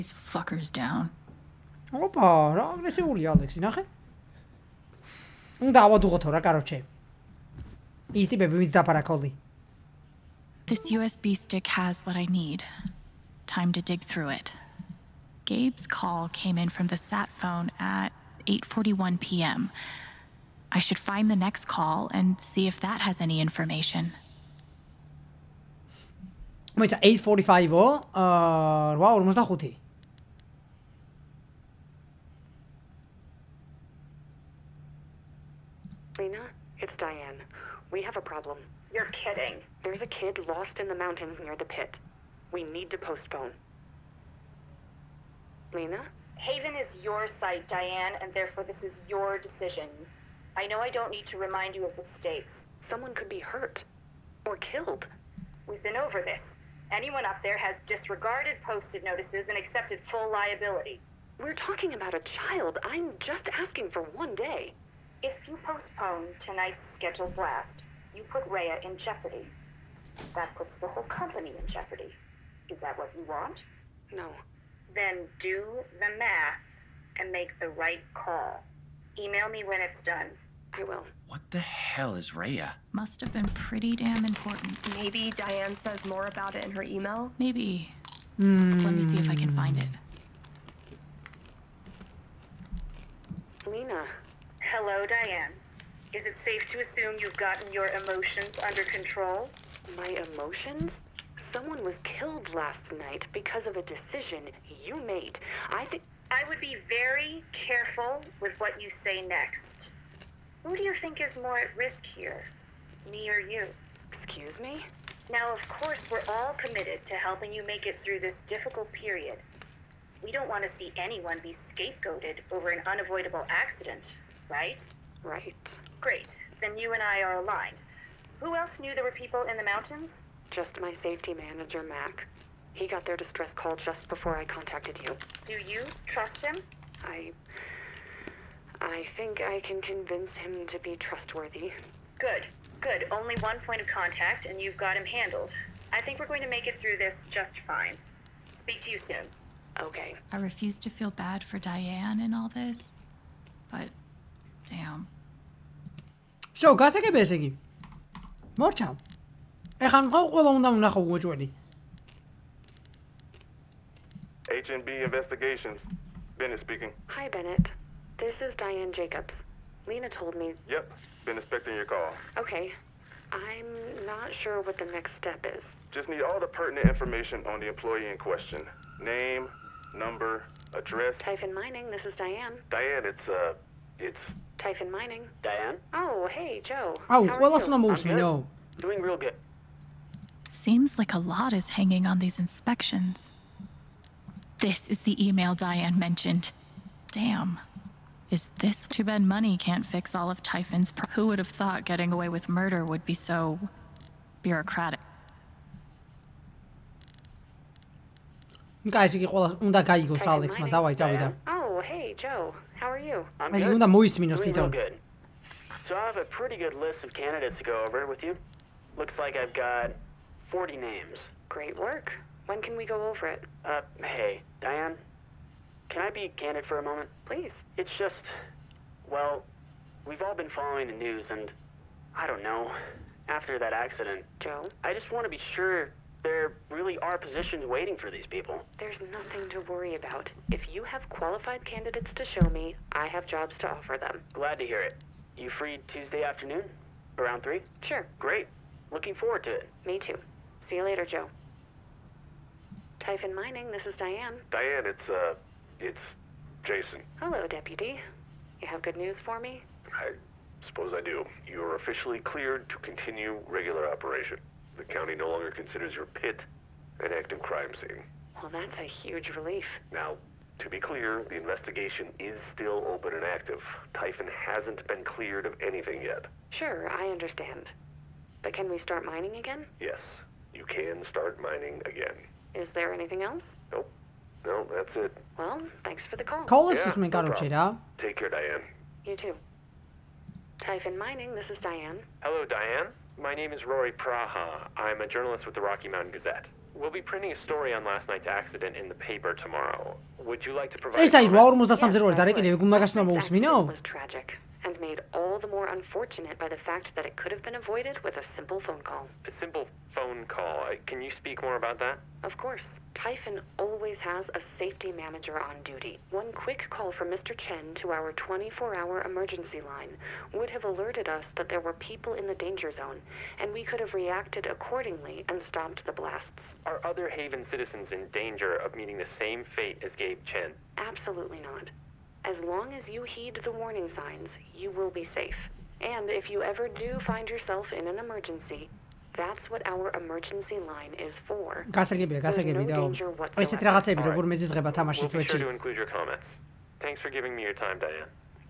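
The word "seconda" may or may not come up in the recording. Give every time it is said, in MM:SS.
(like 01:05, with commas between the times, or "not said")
03:33.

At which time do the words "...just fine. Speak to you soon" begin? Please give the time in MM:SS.
02:27.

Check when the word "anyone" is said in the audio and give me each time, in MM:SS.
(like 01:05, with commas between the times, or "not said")
00:56, 02:00.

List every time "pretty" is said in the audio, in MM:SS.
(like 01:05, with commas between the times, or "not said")
01:23, 03:36.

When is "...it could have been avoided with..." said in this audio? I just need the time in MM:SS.
05:07.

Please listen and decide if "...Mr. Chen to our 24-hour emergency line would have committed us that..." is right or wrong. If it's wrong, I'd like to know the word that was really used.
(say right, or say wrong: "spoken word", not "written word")
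wrong: "alerted", not "committed".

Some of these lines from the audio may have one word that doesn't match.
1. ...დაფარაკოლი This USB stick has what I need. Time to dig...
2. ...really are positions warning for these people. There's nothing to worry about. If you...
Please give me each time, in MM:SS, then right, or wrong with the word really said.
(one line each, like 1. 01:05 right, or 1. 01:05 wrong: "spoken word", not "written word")
1. 00:08 right
2. 03:56 wrong: "waiting", not "warning".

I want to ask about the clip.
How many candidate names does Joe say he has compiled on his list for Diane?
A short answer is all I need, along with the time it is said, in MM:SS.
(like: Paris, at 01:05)
40, at 03:40.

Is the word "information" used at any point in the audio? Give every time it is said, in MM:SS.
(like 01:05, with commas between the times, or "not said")
00:23, 02:56.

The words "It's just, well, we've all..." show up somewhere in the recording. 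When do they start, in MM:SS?
03:47.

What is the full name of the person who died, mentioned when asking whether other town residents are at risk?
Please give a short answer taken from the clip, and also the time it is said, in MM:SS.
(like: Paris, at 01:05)
Gabe Chen, at 05:29.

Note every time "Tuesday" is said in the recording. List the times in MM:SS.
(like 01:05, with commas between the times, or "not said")
04:05.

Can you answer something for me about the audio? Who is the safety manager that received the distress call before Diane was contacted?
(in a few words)
Mac.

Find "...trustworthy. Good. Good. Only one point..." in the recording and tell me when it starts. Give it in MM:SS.
02:20.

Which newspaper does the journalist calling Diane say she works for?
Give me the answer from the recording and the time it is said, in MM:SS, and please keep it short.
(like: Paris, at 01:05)
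Rocky Mountain Gazette, at 04:55.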